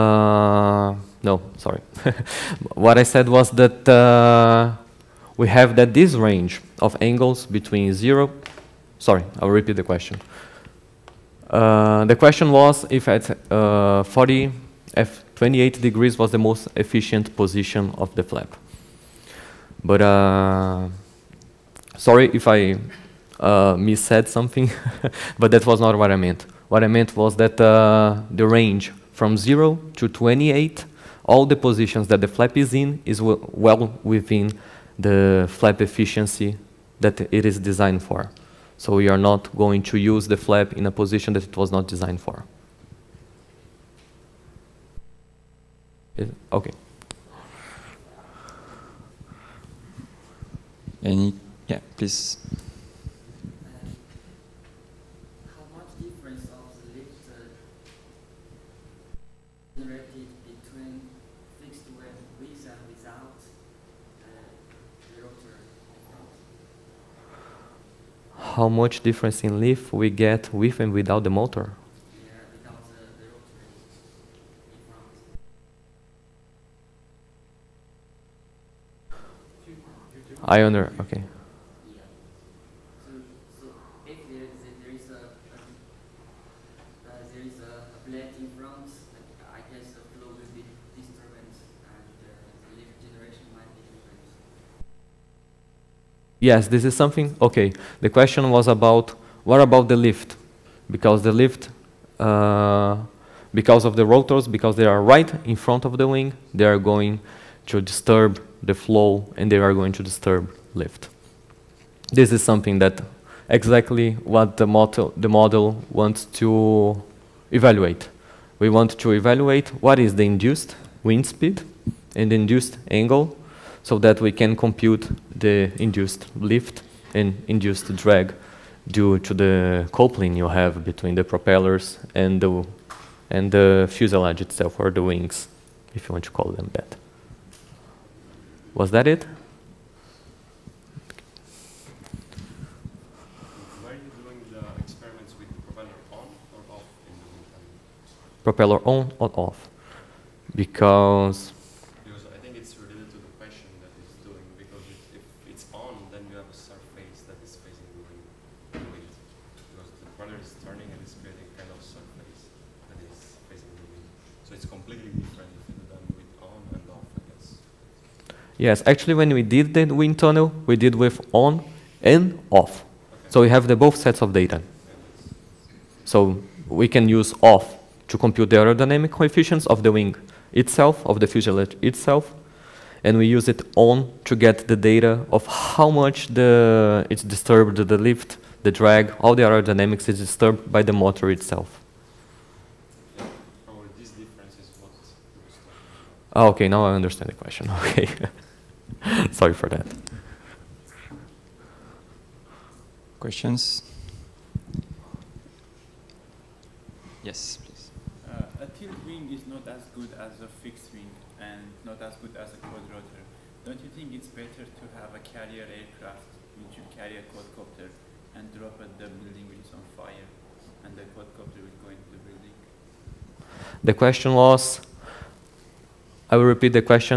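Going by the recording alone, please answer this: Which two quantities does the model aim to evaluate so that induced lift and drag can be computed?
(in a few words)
induced wind speed and induced angle.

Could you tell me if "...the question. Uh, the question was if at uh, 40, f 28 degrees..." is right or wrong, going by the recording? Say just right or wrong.
right.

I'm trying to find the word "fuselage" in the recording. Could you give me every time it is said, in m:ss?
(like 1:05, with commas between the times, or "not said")
2:13, 3:01.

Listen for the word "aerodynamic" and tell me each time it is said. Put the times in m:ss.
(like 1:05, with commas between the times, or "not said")
2:58, 3:09.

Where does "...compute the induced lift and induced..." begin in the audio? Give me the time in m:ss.
2:04.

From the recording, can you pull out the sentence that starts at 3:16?
Oh, okay, now I understand the question.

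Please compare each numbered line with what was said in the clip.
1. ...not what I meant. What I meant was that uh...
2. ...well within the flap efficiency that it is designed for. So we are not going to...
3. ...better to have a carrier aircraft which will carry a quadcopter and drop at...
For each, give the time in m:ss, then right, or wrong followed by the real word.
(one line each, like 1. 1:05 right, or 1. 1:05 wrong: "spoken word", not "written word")
1. 0:25 right
2. 0:33 right
3. 3:34 right.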